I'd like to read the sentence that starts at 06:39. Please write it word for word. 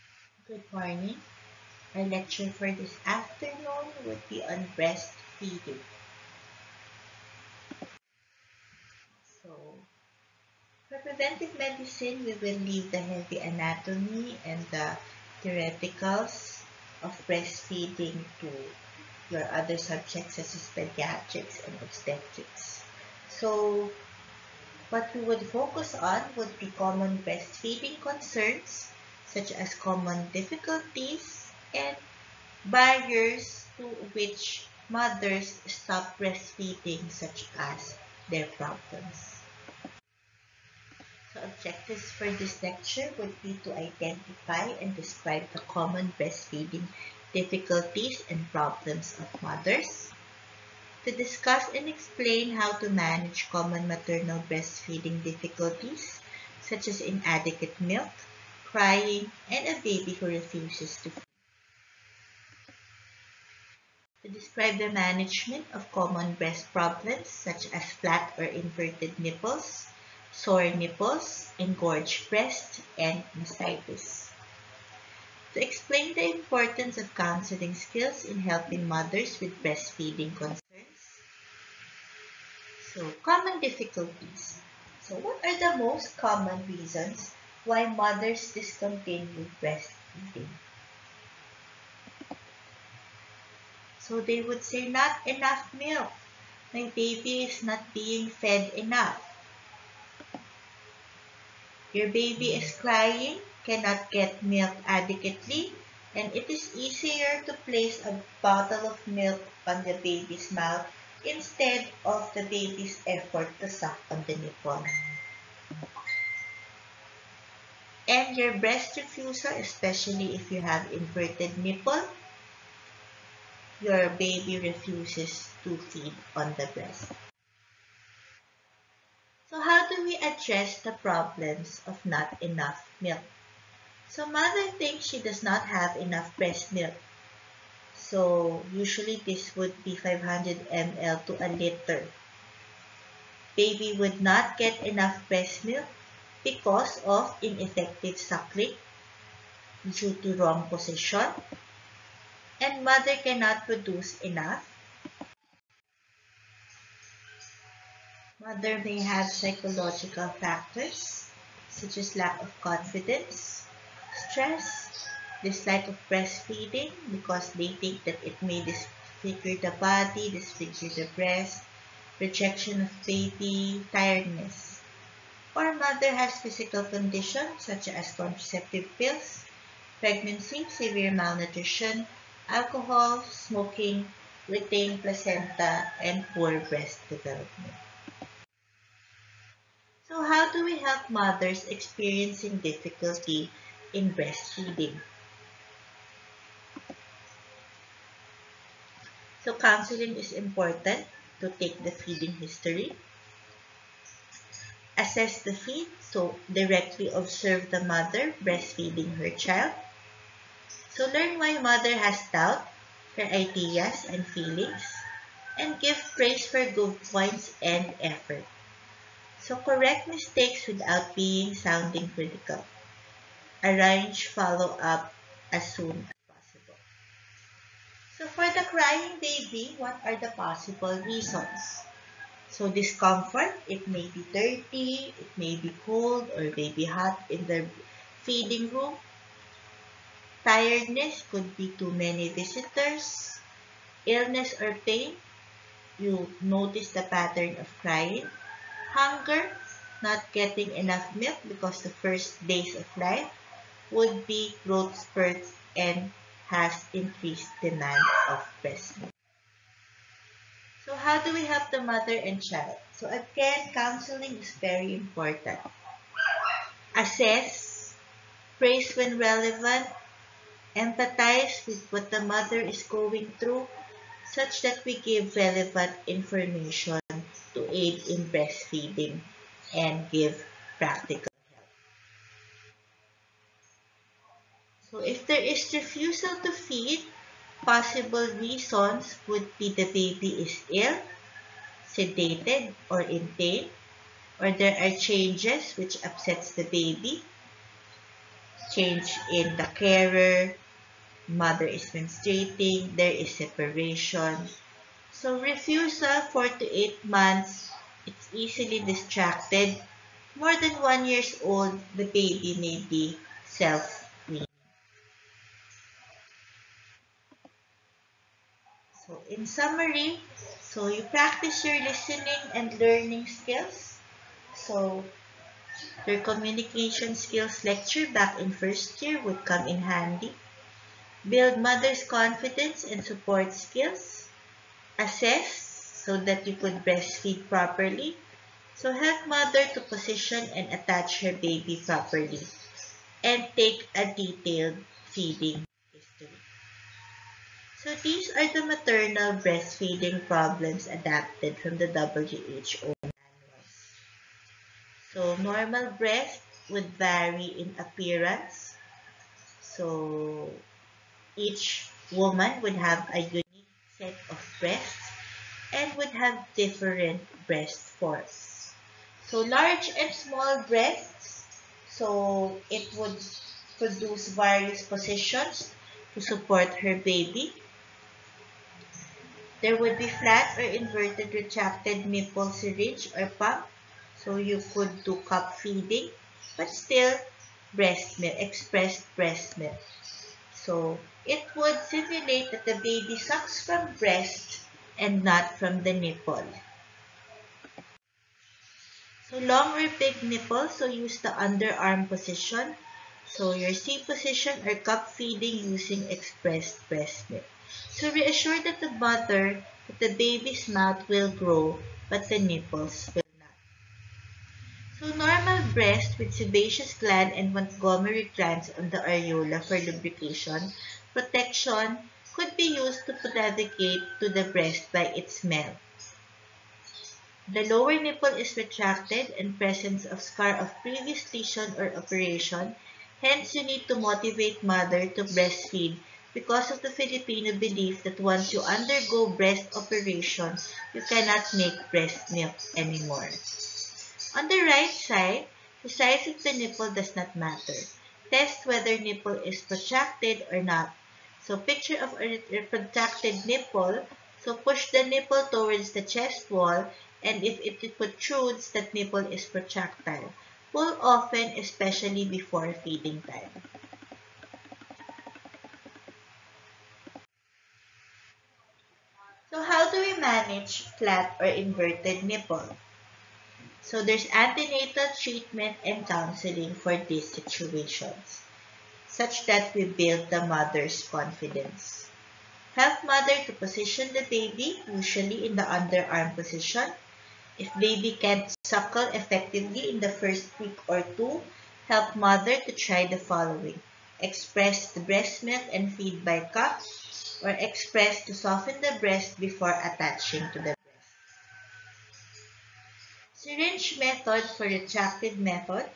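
So long or big nipple, so use the underarm position So, your C position or cup feeding using expressed breast milk.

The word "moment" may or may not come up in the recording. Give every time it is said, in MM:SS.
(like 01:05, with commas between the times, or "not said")
not said.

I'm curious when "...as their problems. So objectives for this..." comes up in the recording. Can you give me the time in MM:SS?
00:37.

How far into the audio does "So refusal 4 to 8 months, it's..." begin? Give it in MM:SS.
05:05.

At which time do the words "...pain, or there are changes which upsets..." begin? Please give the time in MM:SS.
04:53.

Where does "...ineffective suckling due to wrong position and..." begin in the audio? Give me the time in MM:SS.
02:27.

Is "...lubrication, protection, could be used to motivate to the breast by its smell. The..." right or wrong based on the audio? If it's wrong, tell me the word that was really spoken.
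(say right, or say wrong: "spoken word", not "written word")
wrong: "predicate", not "motivate".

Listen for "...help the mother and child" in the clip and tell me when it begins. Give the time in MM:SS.
04:21.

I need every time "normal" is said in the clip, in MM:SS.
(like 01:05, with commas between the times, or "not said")
05:55, 06:55.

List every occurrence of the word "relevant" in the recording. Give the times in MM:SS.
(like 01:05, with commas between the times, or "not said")
04:29, 04:35.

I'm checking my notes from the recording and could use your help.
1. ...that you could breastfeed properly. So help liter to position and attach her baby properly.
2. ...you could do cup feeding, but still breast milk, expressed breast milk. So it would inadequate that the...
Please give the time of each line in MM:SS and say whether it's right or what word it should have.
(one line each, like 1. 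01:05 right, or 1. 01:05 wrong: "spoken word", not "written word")
1. 05:36 wrong: "mother", not "liter"
2. 06:24 wrong: "simulate", not "inadequate".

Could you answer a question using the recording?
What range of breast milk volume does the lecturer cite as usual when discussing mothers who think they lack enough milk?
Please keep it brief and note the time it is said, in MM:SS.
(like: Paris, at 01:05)
500 ml to a liter, at 02:19.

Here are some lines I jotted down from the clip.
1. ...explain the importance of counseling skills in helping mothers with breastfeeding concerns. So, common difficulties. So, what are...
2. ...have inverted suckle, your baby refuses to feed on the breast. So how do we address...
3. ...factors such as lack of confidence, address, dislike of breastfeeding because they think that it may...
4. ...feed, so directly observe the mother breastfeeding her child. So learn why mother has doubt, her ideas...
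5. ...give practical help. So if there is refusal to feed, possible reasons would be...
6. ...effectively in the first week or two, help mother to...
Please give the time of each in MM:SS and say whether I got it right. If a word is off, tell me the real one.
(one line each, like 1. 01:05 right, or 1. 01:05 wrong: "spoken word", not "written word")
1. 01:15 right
2. 02:00 wrong: "nipple", not "suckle"
3. 02:40 wrong: "stress", not "address"
4. 03:25 right
5. 04:40 right
6. 08:09 right.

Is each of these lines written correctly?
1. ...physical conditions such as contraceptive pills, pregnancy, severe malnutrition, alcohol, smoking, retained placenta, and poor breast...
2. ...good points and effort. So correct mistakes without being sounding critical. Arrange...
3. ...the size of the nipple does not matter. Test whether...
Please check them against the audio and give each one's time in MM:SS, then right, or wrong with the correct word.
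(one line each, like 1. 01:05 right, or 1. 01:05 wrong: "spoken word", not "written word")
1. 02:56 right
2. 03:36 right
3. 07:25 right.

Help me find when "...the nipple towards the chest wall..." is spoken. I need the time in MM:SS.
07:34.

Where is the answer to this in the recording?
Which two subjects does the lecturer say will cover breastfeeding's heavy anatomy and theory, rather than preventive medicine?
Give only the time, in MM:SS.
00:20.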